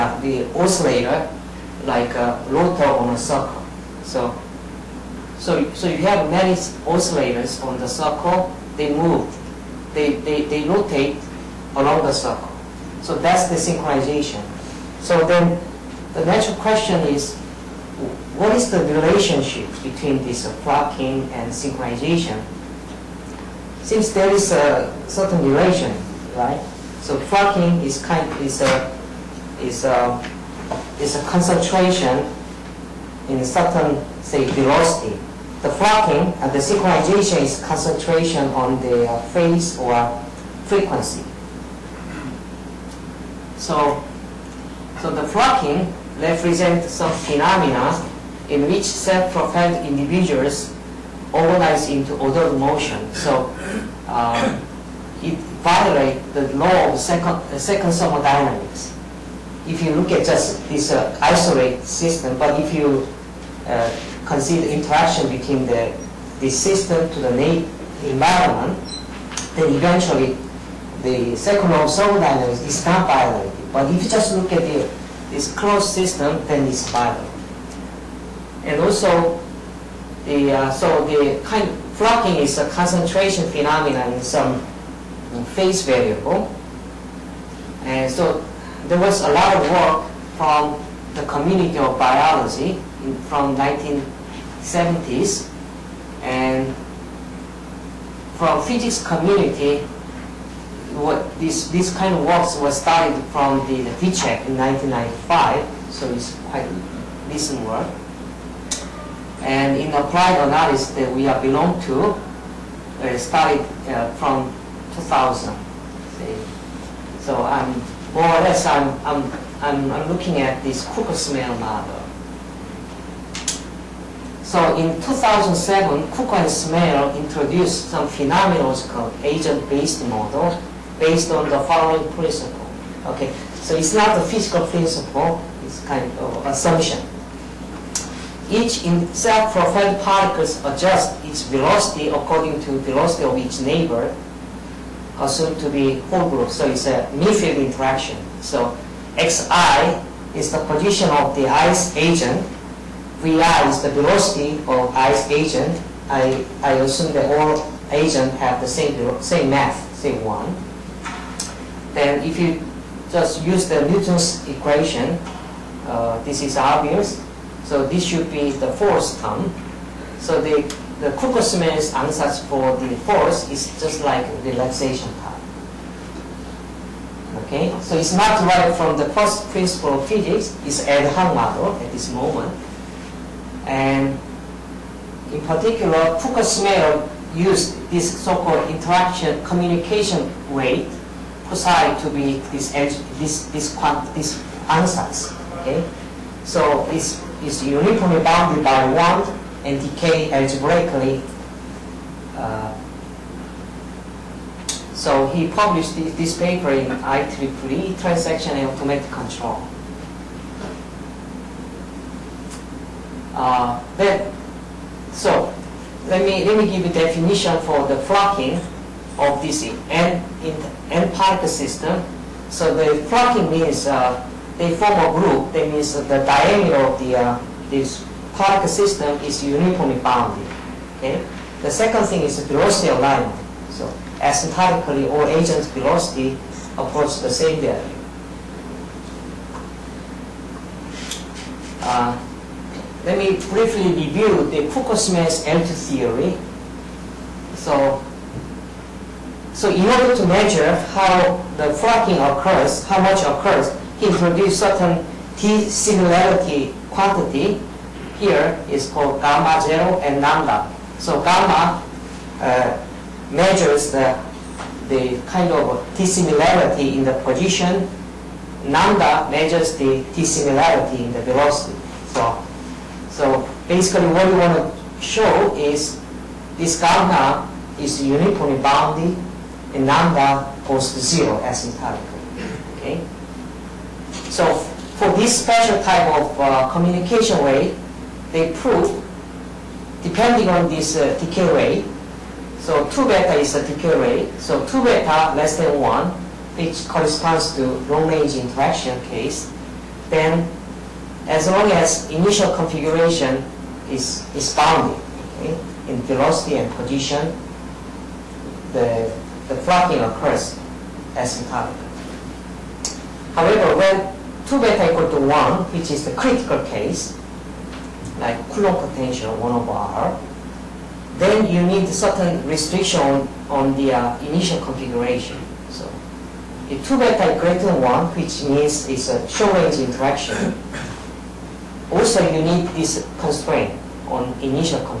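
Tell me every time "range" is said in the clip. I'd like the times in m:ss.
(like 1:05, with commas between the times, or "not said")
4:57, 5:29.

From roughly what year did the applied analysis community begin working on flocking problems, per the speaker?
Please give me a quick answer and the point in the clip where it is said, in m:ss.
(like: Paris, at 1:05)
2000, at 1:54.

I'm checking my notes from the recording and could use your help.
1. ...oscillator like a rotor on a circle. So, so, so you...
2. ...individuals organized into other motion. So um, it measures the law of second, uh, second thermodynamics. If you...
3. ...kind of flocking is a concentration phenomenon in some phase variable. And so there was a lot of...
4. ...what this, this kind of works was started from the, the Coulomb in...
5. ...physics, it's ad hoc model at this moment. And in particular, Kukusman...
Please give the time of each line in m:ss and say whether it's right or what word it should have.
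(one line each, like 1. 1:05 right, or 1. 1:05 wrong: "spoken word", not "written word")
1. 0:00 right
2. 0:49 wrong: "violates", not "measures"
3. 1:21 right
4. 1:40 wrong: "Vicsek", not "Coulomb"
5. 3:00 right.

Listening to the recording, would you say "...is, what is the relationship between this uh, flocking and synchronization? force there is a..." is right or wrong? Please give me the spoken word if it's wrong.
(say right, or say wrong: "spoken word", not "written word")
wrong: "since", not "force".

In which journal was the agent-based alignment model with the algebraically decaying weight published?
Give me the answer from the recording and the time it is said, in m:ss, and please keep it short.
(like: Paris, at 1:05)
IEEE Transaction and Automatic Control, at 3:26.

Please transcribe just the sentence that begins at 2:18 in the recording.
Each in self-propelled particles adjusts its velocity according to velocity of its neighbor, assumed to be whole group.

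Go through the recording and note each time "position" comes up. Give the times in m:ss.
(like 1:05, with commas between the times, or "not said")
2:30, 4:27, 5:06.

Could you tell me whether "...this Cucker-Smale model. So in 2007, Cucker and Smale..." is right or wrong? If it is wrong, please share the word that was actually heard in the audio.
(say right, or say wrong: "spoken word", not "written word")
right.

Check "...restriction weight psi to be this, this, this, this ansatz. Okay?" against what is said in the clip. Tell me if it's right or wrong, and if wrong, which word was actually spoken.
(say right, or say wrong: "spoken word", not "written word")
wrong: "communication", not "restriction".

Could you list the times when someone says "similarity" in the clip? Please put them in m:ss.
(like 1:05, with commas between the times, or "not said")
4:15, 4:25, 4:30.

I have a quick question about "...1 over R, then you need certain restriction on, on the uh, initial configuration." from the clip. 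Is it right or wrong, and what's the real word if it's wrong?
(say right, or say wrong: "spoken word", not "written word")
right.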